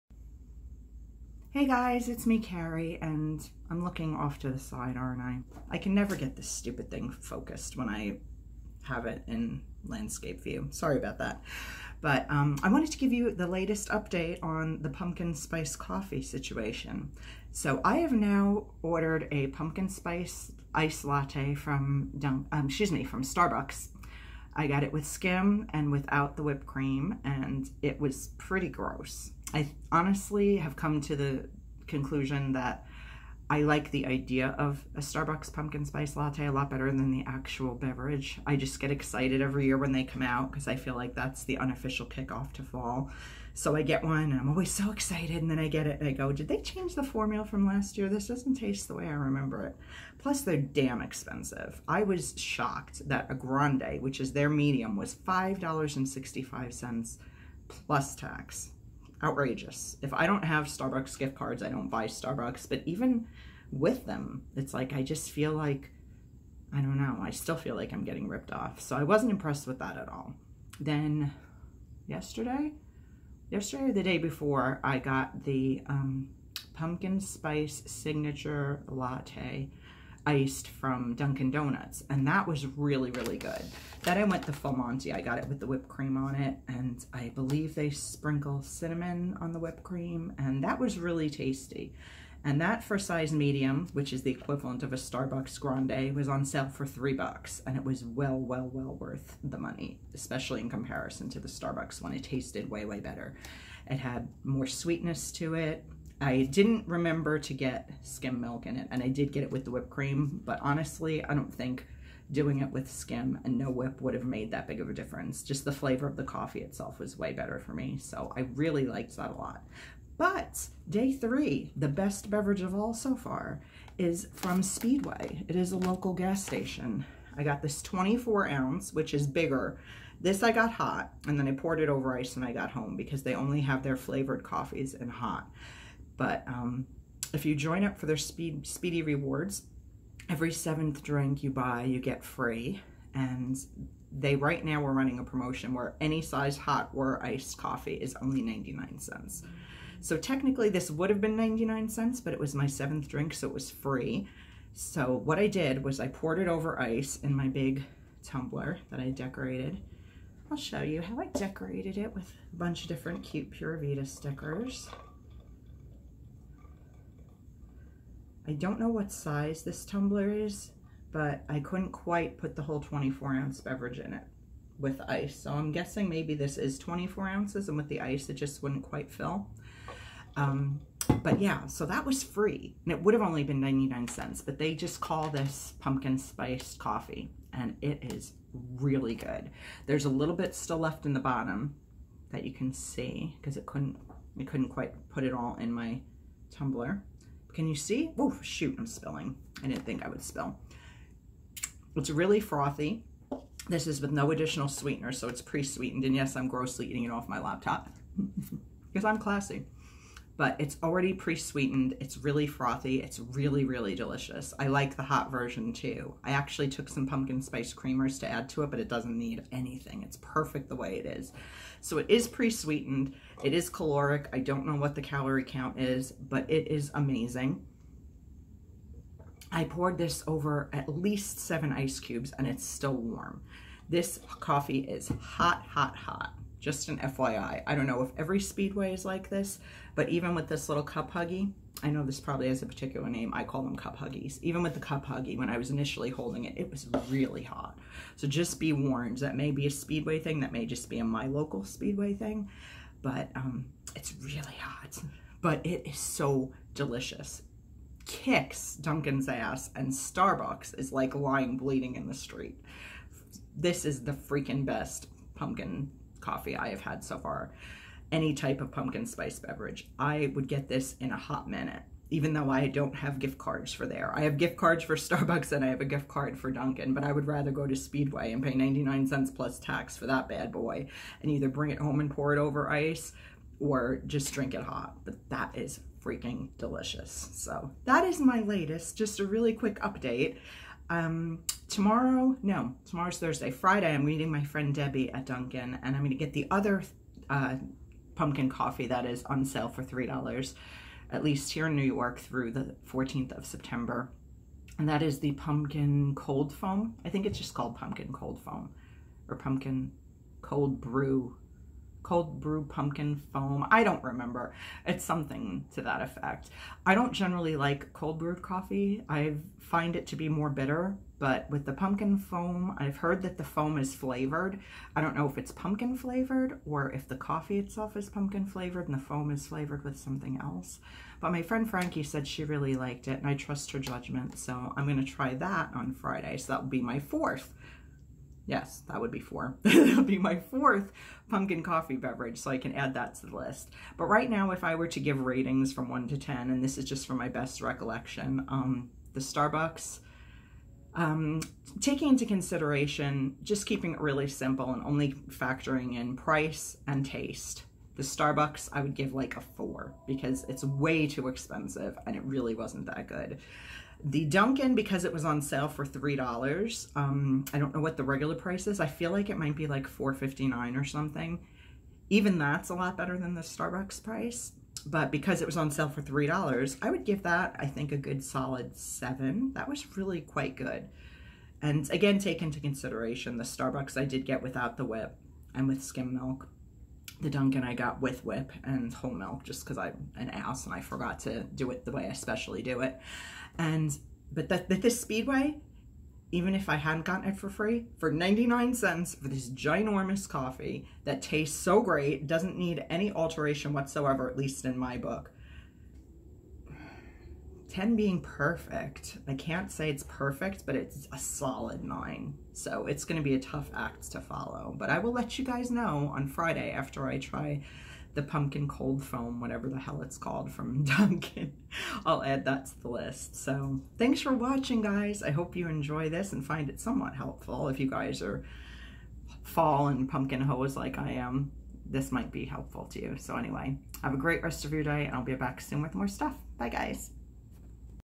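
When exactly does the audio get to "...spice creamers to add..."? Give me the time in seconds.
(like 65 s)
217 s.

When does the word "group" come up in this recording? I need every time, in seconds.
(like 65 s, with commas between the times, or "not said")
not said.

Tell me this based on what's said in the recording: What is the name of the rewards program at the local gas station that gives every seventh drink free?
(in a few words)
Speedy Rewards.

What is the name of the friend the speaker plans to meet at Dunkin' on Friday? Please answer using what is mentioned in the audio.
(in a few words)
Debbie.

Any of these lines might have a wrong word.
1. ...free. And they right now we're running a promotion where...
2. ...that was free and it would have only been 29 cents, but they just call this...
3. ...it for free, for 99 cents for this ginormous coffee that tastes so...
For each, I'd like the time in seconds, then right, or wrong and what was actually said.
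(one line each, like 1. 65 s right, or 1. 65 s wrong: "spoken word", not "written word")
1. 142 s right
2. 181 s wrong: "99", not "29"
3. 397 s right.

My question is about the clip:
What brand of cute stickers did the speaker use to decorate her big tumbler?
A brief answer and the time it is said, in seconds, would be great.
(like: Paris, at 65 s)
Pura, at 163 s.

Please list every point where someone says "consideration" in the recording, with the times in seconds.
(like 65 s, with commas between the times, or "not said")
352 s, 382 s.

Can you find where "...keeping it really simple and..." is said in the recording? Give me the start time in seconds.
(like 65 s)
353 s.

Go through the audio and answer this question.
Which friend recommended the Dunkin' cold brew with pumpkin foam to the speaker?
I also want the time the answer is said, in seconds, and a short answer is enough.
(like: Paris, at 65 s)
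Frankie, at 331 s.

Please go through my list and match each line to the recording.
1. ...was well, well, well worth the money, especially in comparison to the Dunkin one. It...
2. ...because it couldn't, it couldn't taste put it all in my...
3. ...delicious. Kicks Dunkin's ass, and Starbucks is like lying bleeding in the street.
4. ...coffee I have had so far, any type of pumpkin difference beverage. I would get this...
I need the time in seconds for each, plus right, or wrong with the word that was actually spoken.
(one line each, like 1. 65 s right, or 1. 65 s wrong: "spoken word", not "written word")
1. 97 s wrong: "Starbucks", not "Dunkin"
2. 193 s wrong: "quite", not "taste"
3. 256 s right
4. 266 s wrong: "spice", not "difference".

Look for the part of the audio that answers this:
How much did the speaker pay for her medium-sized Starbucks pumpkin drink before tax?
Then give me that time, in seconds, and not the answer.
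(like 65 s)
55 s.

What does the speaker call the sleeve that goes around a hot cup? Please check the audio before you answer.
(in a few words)
cup huggies.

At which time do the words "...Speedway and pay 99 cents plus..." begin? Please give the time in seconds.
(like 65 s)
277 s.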